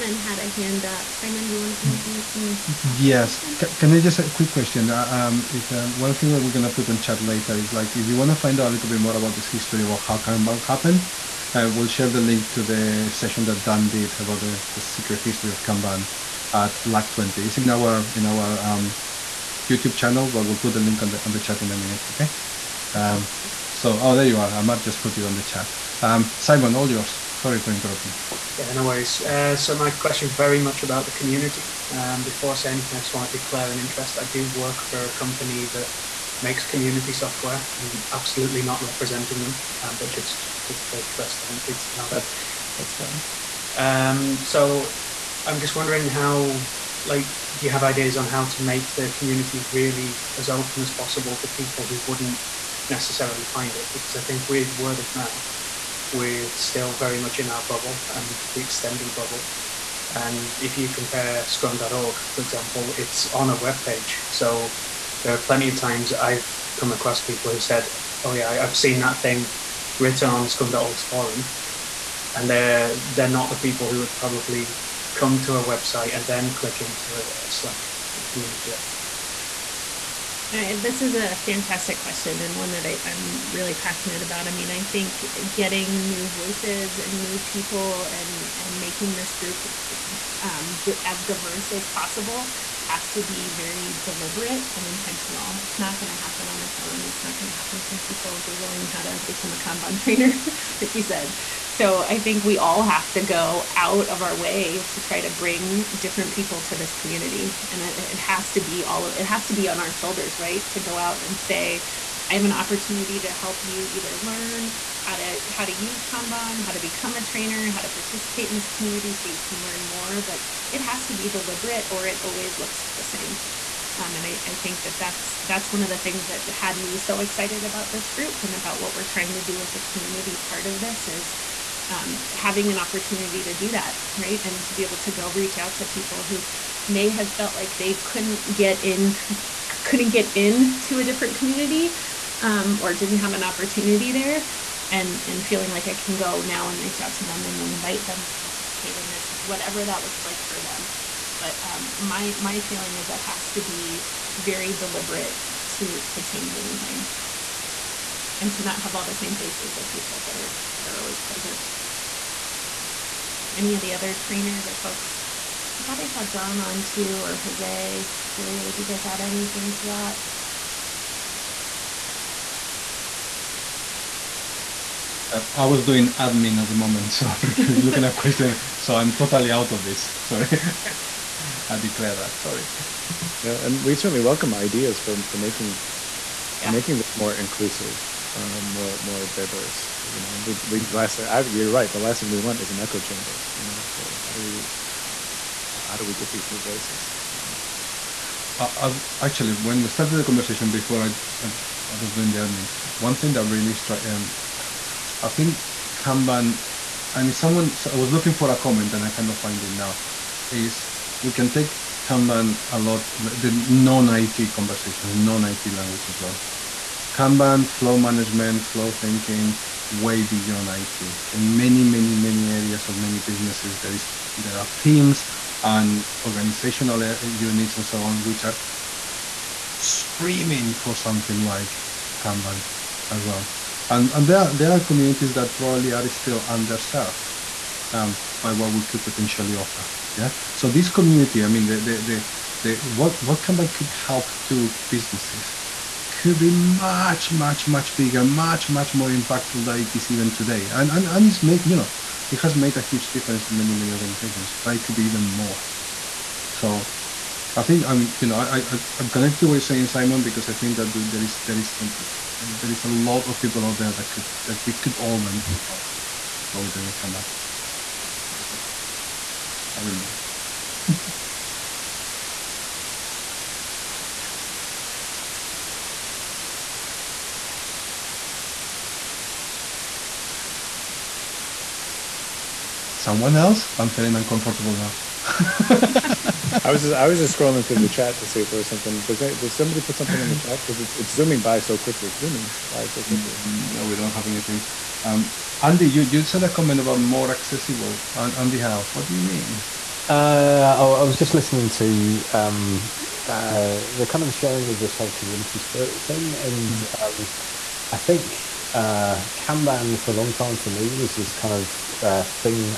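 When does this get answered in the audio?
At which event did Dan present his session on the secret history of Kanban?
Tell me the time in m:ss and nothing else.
0:16.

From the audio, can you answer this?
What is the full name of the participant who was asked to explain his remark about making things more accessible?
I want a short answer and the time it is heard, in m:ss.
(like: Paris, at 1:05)
Andy House, at 4:58.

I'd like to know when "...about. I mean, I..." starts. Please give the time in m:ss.
1:24.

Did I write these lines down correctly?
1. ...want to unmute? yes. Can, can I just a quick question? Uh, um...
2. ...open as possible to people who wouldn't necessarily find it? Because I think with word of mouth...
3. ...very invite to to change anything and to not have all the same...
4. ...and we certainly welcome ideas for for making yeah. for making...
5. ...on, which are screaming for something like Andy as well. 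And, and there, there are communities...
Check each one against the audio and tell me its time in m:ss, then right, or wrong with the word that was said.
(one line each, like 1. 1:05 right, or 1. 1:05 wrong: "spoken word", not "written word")
1. 0:01 right
2. 0:50 right
3. 2:34 wrong: "deliberate", not "invite"
4. 3:03 right
5. 3:48 wrong: "Kanban", not "Andy".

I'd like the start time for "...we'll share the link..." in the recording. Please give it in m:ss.
0:11.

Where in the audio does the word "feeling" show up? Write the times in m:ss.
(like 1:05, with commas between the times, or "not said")
2:25, 2:32, 4:43.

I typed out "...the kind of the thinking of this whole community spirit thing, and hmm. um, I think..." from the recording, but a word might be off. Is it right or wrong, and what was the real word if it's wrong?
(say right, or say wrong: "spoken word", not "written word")
wrong: "sharing", not "thinking".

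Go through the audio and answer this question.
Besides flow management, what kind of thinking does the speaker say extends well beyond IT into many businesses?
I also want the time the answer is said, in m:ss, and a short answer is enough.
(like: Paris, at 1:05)
flow thinking, at 3:38.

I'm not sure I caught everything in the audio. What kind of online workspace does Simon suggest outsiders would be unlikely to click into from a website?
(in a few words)
Slack community.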